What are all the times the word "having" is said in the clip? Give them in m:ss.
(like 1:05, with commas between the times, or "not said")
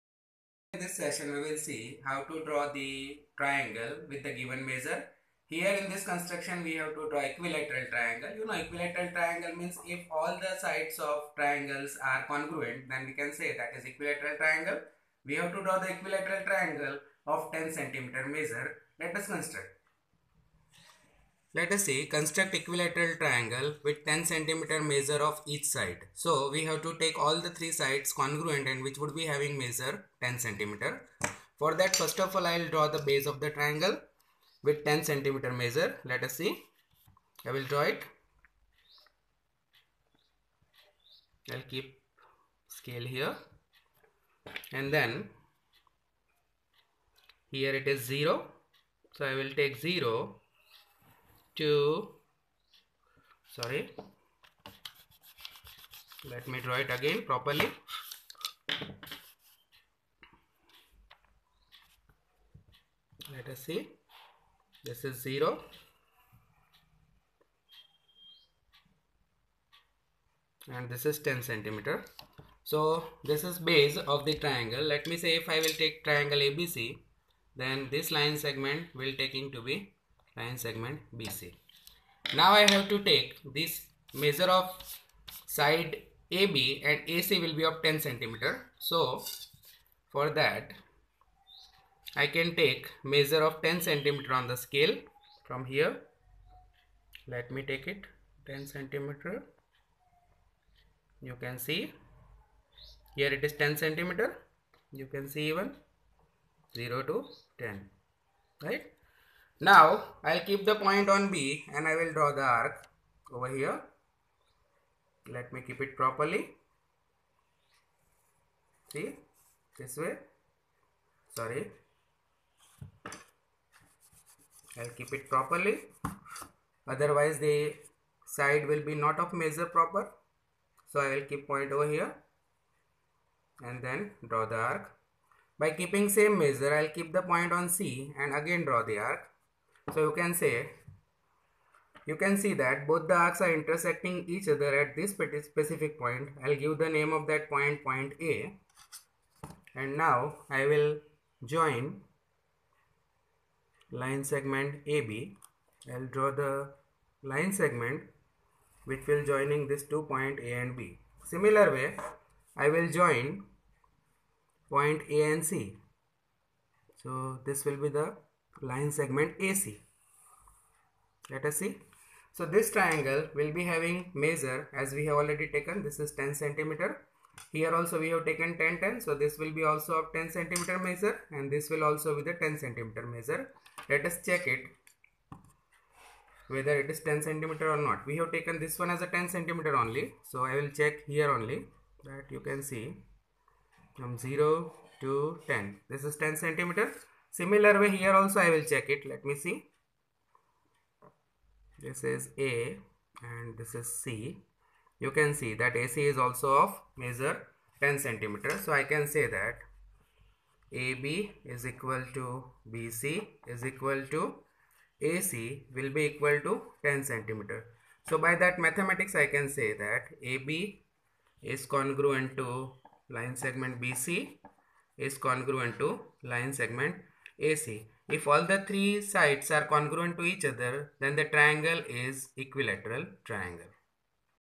0:29, 2:53.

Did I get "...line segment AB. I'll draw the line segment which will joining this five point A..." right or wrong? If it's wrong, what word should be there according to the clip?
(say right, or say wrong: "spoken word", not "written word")
wrong: "two", not "five".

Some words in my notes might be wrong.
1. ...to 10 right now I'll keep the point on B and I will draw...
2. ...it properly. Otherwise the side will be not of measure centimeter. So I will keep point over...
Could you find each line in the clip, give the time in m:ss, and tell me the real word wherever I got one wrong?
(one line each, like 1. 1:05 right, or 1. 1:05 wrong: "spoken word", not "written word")
1. 1:47 right
2. 2:05 wrong: "proper", not "centimeter".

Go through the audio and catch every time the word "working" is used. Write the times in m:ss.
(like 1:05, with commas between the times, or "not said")
not said.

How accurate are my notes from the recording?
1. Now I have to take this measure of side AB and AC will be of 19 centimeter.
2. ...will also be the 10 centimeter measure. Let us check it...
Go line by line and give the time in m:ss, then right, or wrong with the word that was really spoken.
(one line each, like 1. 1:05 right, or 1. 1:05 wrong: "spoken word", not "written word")
1. 1:22 wrong: "10", not "19"
2. 3:01 right.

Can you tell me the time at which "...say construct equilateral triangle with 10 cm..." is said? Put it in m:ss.
0:21.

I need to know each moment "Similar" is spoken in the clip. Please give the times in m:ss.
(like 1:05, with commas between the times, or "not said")
2:41, 3:17.